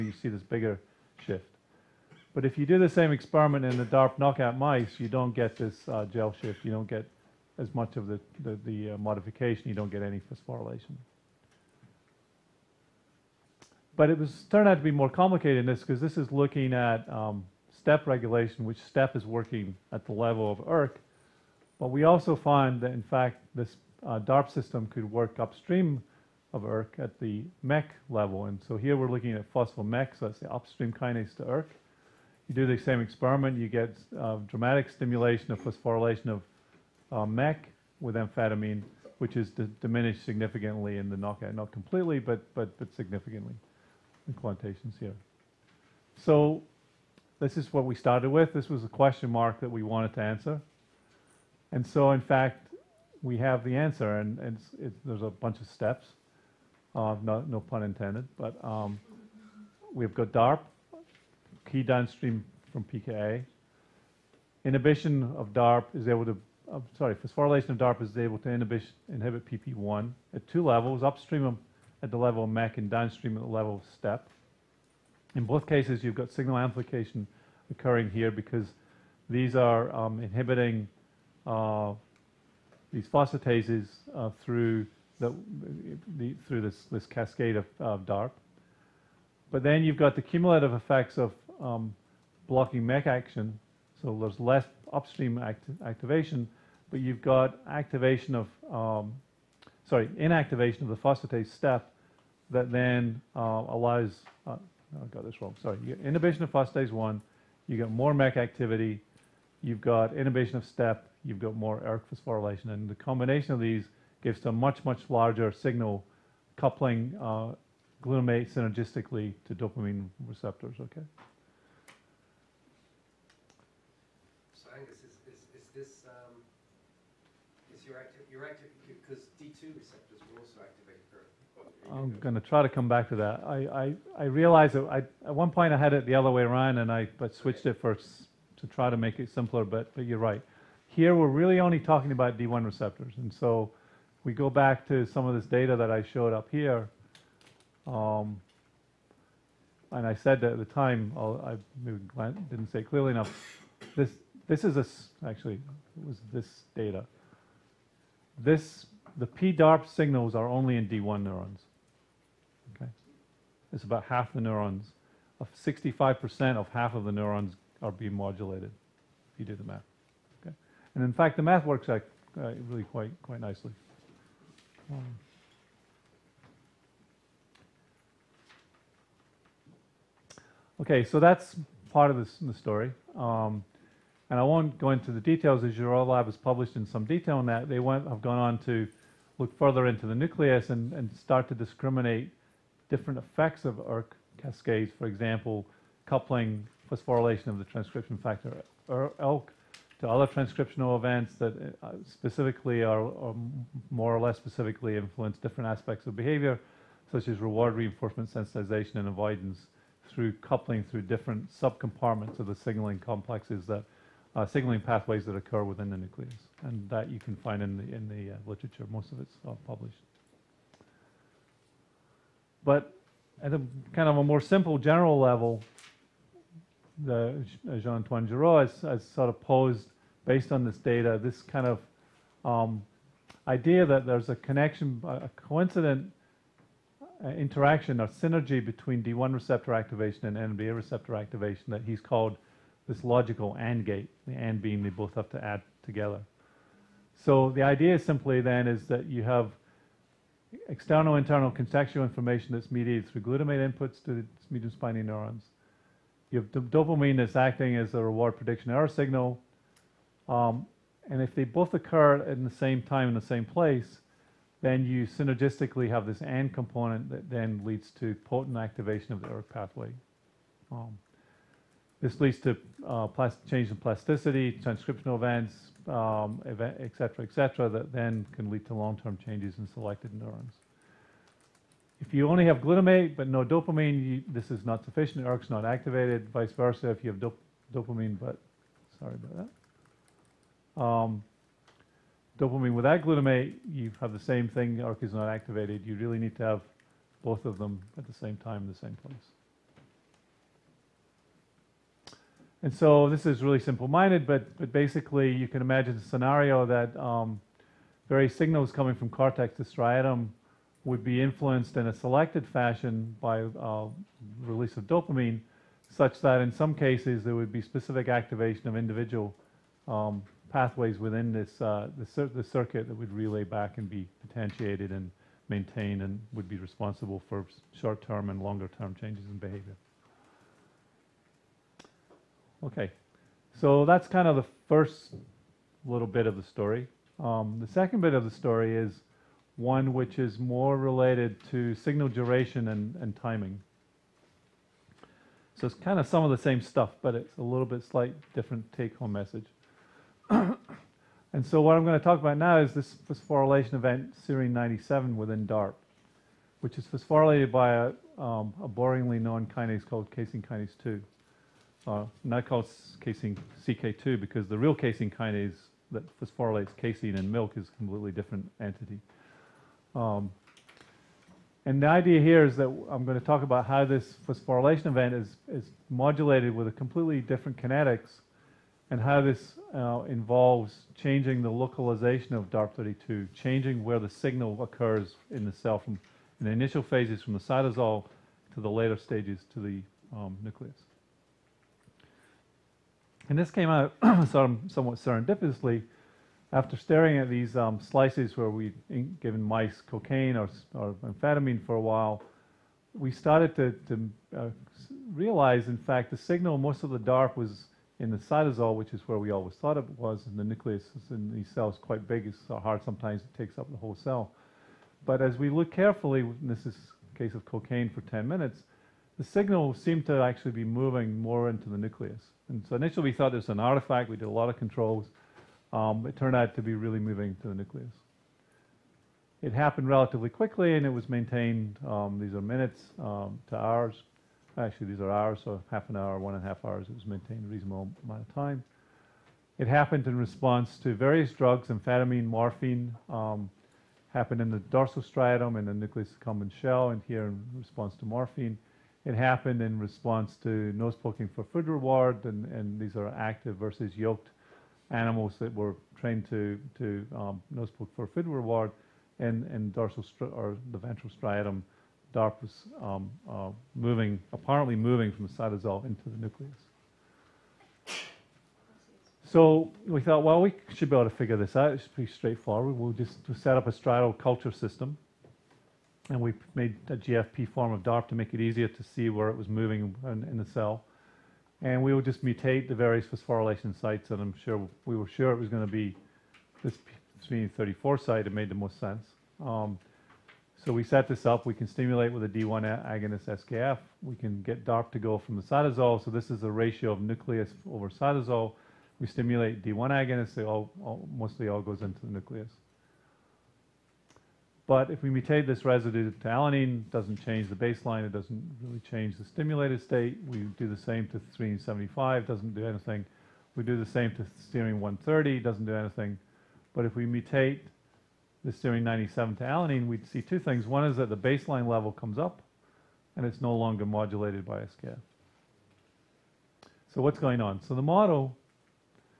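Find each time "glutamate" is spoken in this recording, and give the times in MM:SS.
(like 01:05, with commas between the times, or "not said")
01:58, 04:13, 04:42, 04:53.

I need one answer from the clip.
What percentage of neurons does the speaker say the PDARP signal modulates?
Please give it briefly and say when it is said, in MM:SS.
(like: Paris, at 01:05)
65%, at 02:45.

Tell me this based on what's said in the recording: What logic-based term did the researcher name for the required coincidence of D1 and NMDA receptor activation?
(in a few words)
logical AND gate.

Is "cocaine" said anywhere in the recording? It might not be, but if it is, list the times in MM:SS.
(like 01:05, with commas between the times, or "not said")
06:39, 06:57.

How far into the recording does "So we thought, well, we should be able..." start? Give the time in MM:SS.
07:49.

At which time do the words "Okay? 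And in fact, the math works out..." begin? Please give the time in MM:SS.
02:50.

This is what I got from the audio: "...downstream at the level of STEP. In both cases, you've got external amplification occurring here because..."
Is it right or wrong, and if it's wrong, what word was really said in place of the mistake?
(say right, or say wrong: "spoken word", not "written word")
wrong: "signal", not "external".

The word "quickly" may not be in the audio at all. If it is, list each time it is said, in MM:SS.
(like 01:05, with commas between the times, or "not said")
07:10.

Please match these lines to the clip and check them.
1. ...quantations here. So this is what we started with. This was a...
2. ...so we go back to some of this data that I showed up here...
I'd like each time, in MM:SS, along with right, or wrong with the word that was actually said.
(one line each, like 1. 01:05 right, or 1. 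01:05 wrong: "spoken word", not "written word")
1. 00:44 right
2. 02:23 right.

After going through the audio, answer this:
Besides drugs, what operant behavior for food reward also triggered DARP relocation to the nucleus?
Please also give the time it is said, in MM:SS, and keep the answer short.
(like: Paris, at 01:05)
nose poking, at 07:30.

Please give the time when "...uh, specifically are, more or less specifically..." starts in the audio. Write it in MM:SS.
03:21.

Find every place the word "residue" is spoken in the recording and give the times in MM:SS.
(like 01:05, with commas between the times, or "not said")
08:25.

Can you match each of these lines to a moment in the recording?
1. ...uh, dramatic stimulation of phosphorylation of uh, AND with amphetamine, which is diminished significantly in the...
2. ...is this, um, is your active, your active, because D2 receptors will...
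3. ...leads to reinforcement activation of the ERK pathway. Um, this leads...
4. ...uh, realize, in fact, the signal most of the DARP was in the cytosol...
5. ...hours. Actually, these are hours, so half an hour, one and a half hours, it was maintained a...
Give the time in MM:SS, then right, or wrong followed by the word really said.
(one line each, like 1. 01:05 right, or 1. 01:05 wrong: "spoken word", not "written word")
1. 00:34 wrong: "MEK", not "AND"
2. 02:05 right
3. 04:27 wrong: "potent", not "reinforcement"
4. 06:44 right
5. 07:13 right.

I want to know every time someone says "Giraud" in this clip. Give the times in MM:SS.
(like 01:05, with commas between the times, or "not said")
03:48.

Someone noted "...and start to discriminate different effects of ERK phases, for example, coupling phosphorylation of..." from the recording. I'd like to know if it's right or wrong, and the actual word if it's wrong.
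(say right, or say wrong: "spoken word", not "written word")
wrong: "cascades", not "phases".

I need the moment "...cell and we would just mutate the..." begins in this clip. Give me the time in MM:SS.
08:00.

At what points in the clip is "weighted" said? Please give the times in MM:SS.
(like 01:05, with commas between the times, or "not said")
not said.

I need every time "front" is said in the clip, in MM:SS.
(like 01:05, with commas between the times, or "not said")
not said.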